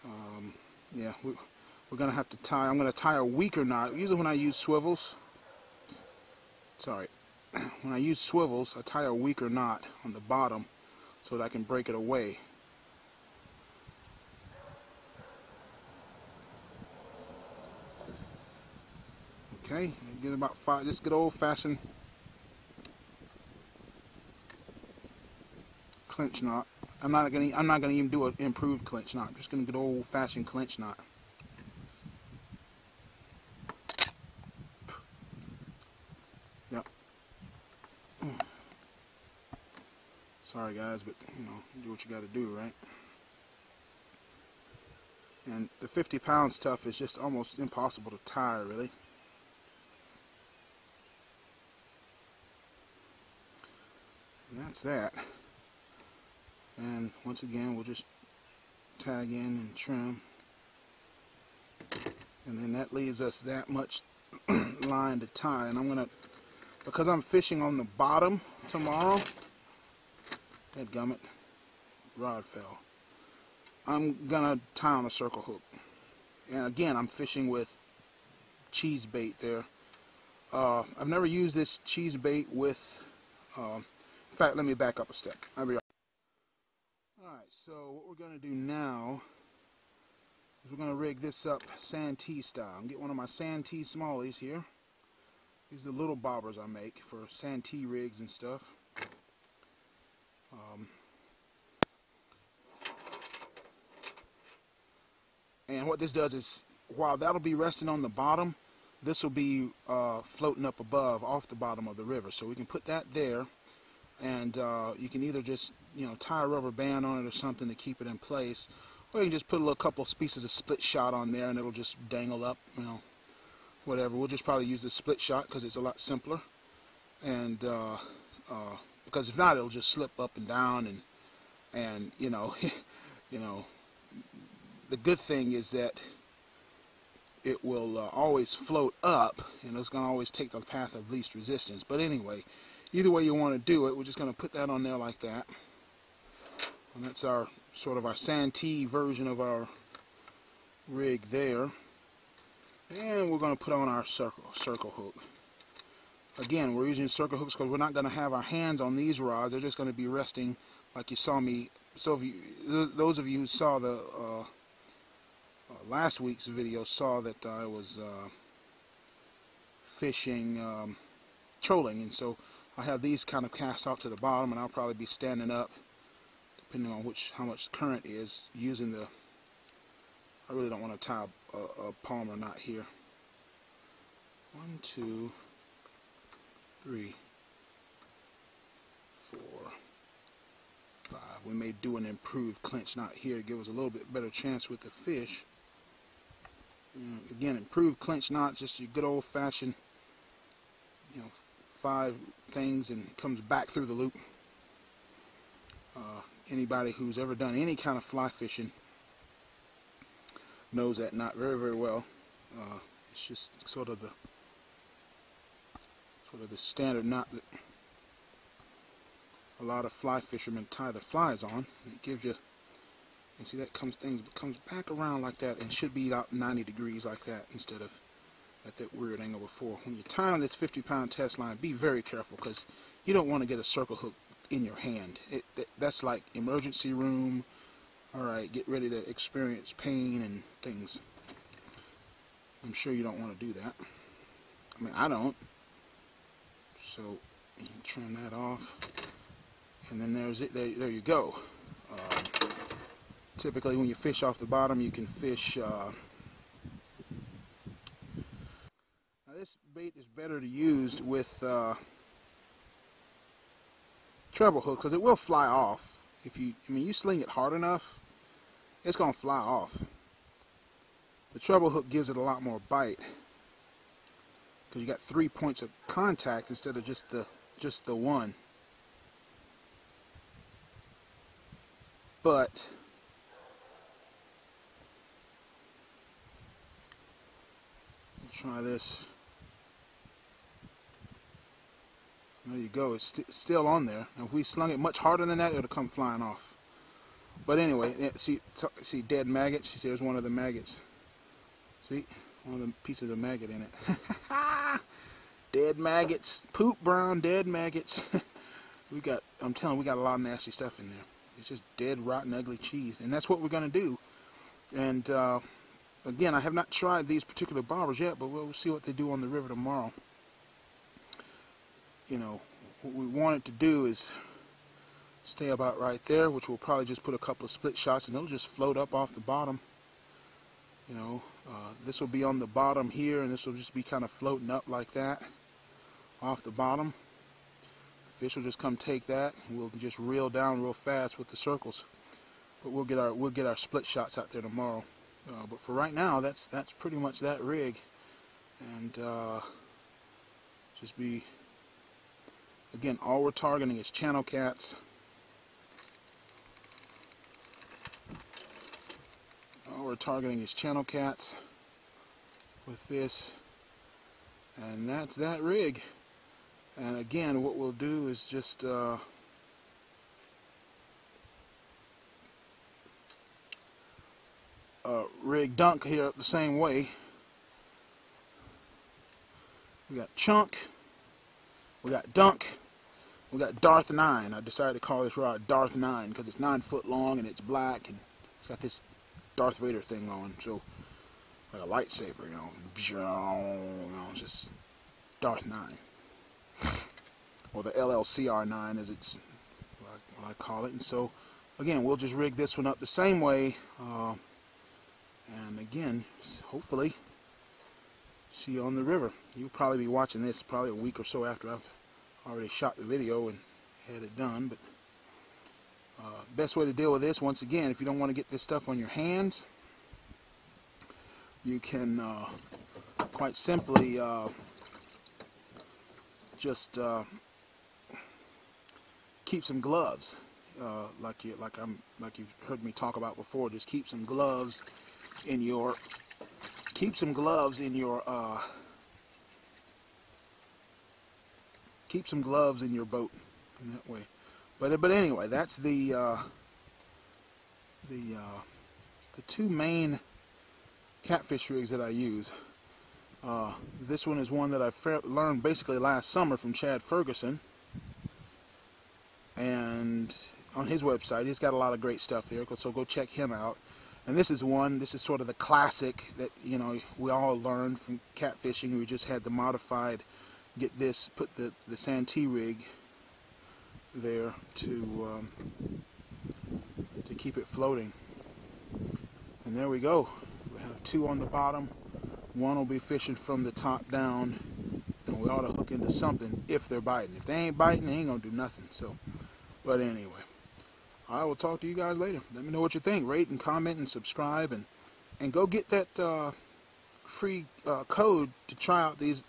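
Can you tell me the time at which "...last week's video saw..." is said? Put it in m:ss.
2:45.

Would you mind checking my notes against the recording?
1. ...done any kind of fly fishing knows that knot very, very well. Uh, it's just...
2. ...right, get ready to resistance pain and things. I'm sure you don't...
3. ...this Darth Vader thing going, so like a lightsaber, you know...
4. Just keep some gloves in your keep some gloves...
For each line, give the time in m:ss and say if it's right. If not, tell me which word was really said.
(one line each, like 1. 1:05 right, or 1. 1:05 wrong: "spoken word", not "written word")
1. 3:27 right
2. 3:58 wrong: "experience", not "resistance"
3. 6:28 right
4. 7:13 right.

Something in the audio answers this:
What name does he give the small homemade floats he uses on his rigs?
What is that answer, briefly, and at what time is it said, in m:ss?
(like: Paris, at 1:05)
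Santee smallies, at 1:33.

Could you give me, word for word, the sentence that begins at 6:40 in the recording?
And so, again, we'll just rig this one up the same way, uh, and again, hopefully, see you on the river.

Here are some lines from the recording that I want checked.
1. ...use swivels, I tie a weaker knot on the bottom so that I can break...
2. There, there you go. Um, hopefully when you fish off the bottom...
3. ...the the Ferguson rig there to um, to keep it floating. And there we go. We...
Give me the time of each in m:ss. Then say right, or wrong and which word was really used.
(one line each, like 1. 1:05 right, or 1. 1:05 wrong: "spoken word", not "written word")
1. 0:07 right
2. 4:10 wrong: "typically", not "hopefully"
3. 7:51 wrong: "Santee", not "Ferguson".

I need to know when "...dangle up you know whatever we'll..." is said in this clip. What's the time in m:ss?
2:02.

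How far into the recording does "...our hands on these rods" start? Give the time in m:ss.
2:38.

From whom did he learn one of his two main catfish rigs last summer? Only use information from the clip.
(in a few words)
Chad Ferguson.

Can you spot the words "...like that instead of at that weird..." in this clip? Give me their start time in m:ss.
3:47.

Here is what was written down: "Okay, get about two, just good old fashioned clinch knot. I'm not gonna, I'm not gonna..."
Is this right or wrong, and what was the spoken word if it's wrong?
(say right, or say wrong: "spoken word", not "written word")
wrong: "five", not "two".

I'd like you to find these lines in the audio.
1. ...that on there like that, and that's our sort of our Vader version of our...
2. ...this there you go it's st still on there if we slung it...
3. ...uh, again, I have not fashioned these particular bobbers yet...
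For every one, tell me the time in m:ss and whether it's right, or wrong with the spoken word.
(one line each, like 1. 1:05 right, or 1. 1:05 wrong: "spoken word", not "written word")
1. 2:24 wrong: "Santee", not "Vader"
2. 4:48 right
3. 5:15 wrong: "tried", not "fashioned".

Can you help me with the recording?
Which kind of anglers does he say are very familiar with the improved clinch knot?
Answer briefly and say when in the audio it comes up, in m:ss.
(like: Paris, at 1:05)
fly fishermen, at 3:39.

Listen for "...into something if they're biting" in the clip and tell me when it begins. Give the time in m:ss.
8:05.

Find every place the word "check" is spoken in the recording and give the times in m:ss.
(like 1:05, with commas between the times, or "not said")
7:42.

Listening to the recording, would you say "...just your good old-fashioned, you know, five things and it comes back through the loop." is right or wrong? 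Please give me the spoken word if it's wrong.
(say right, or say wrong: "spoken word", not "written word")
right.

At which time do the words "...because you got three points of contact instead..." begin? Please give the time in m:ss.
4:34.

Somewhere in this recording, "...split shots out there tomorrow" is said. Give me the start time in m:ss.
5:43.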